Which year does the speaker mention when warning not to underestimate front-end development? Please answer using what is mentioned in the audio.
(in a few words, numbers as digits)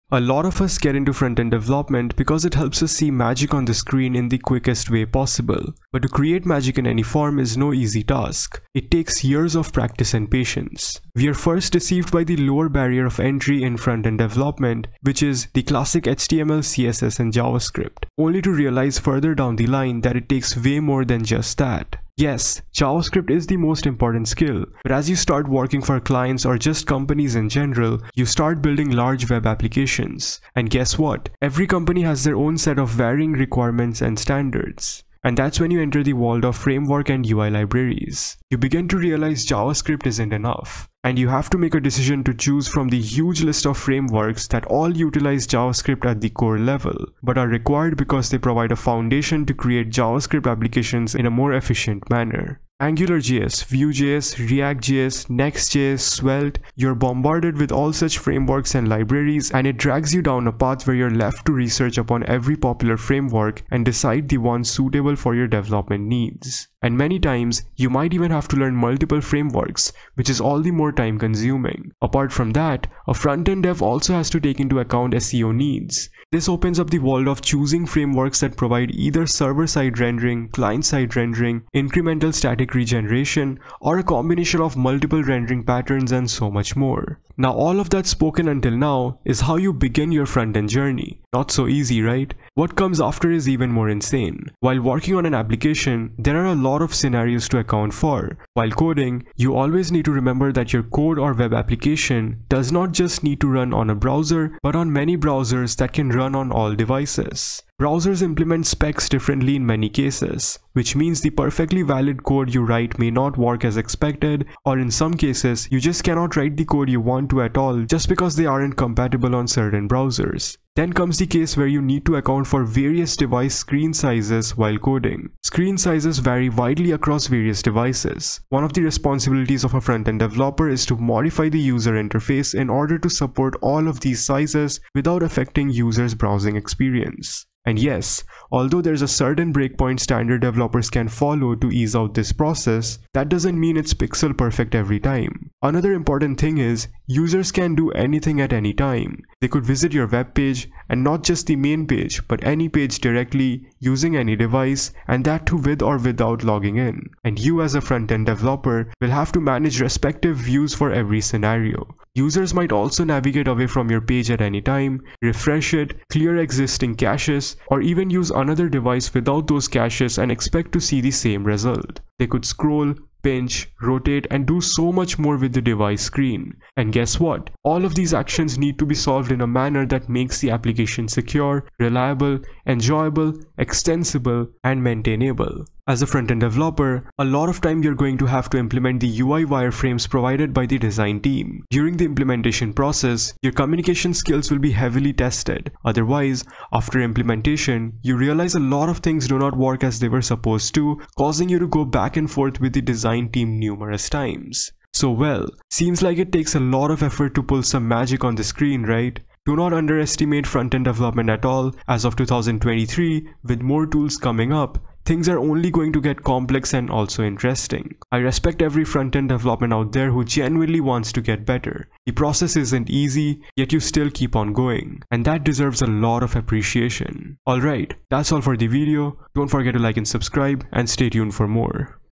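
2023.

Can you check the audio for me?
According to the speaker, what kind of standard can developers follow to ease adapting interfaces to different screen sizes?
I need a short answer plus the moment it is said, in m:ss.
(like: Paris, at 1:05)
Breakpoint standard, at 2:19.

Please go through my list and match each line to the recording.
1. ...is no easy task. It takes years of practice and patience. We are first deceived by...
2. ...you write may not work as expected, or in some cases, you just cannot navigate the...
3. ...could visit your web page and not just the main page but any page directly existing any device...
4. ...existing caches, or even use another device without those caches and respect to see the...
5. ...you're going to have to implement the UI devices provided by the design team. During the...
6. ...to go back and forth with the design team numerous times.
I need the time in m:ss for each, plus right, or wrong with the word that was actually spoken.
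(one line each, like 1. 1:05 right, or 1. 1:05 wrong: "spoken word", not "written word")
1. 0:07 right
2. 1:52 wrong: "write", not "navigate"
3. 2:29 wrong: "using", not "existing"
4. 2:46 wrong: "expect", not "respect"
5. 3:07 wrong: "wireframes", not "devices"
6. 3:21 right.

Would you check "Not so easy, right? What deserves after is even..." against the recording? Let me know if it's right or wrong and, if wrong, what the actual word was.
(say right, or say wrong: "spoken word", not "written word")
wrong: "comes", not "deserves".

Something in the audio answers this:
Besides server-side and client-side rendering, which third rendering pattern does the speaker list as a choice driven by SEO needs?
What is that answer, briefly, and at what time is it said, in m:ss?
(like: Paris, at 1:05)
Incremental static regeneration, at 1:21.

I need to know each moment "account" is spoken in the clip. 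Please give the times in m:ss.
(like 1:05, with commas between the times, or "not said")
1:14, 1:37, 2:02.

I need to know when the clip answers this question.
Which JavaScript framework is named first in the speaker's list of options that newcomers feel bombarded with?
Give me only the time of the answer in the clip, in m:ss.
0:52.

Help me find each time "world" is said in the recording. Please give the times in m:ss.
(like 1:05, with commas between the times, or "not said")
0:36, 1:16.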